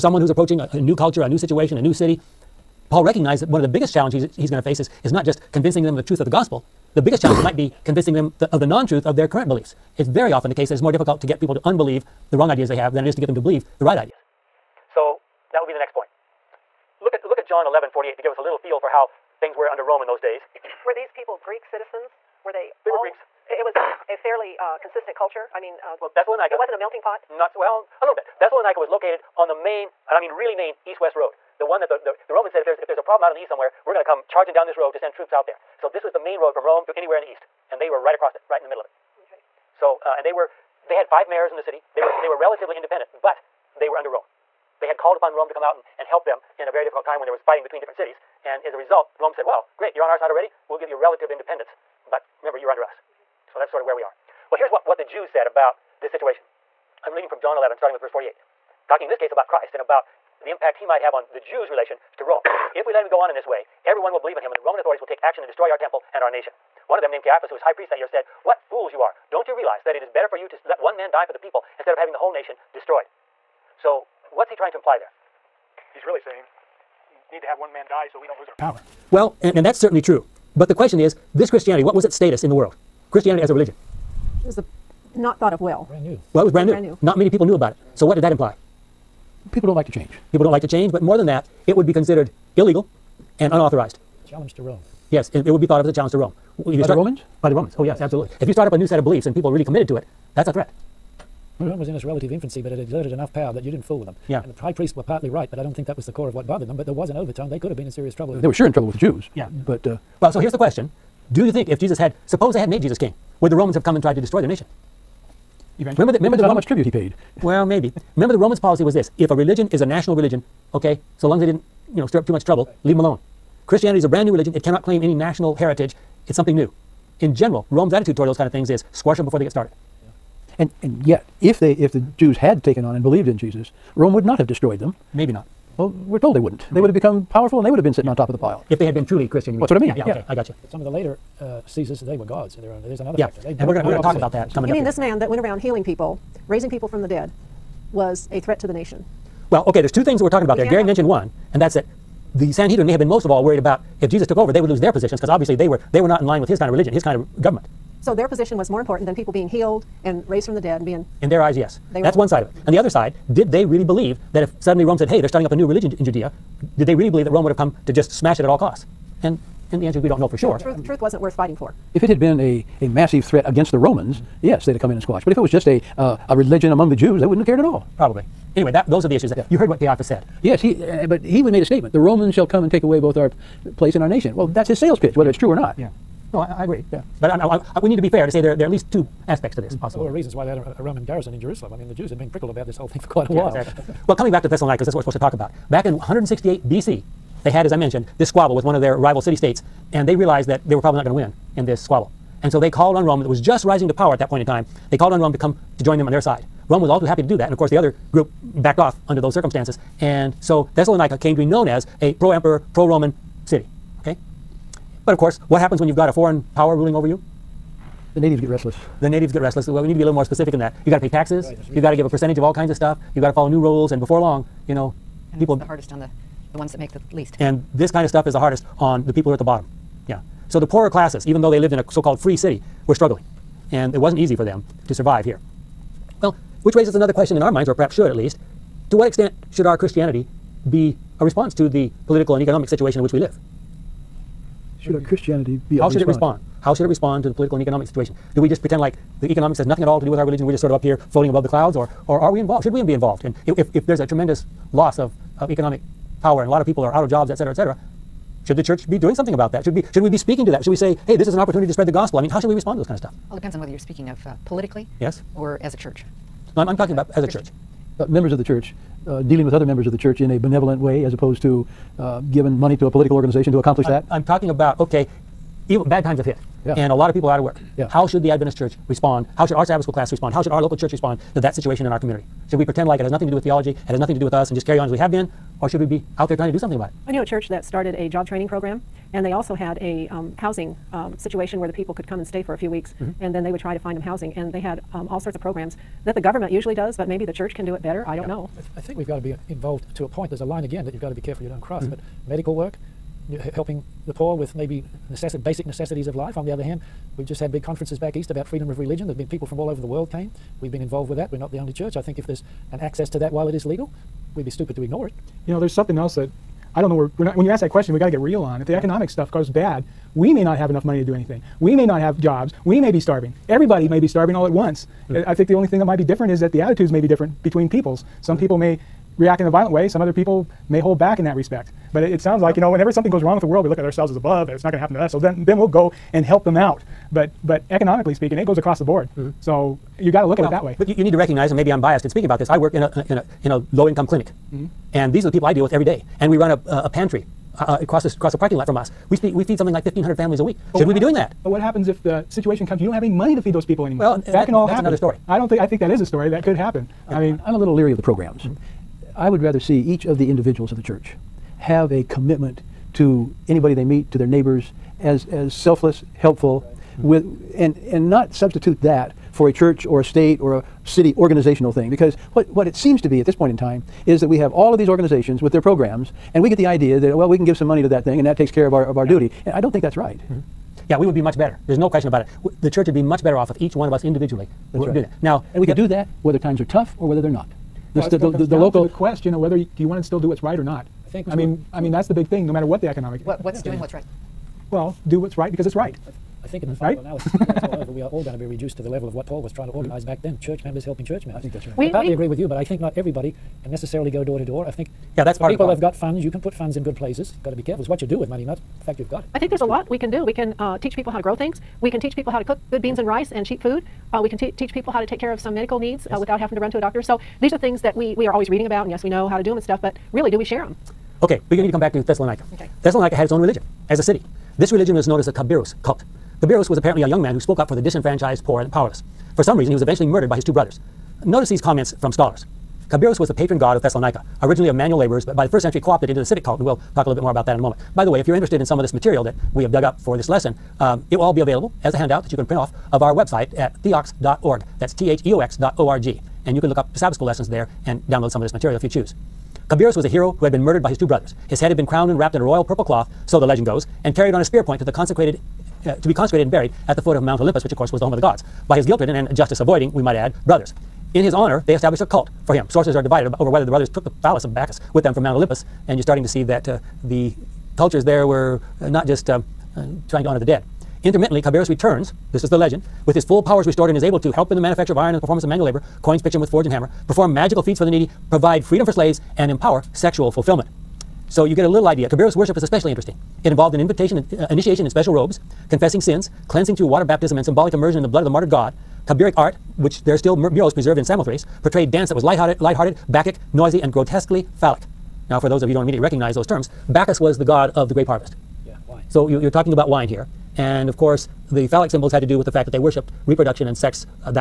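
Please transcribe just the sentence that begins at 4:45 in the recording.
Or should we be out there trying to do something about it?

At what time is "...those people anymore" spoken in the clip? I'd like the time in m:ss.
5:53.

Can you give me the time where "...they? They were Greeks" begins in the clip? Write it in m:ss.
0:22.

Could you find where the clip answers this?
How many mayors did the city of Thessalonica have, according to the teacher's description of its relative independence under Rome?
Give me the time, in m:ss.
0:41.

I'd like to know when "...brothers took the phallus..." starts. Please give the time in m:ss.
7:43.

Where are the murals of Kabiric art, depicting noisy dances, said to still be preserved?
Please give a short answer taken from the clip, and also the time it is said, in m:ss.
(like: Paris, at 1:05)
Samothrace, at 8:11.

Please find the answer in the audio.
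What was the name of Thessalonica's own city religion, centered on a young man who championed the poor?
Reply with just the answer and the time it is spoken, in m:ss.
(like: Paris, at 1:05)
Kabiros cult, at 7:05.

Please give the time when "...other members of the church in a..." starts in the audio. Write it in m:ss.
4:29.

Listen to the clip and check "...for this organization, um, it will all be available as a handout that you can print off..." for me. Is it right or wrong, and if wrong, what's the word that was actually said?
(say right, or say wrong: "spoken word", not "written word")
wrong: "lesson", not "organization".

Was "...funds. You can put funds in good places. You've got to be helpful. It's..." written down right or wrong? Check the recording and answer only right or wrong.
wrong.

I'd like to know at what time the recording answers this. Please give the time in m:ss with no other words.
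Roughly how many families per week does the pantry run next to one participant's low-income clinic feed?
5:49.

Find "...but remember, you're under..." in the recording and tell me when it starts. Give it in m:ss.
0:52.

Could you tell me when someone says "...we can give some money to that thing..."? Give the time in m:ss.
6:17.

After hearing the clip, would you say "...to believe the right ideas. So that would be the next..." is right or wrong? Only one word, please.
right.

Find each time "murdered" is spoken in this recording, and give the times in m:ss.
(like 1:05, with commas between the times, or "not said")
7:10, 7:30.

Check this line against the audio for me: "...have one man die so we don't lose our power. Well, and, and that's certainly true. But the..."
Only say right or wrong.
right.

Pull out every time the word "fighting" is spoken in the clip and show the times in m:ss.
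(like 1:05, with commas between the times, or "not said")
0:47, 2:51.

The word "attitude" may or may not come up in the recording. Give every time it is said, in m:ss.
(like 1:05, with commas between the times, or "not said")
2:07, 5:26.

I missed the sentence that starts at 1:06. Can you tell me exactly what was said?
One of them, named Caiaphas, who was high priest that year, said, What fools you are!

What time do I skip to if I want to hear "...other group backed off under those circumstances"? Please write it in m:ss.
3:27.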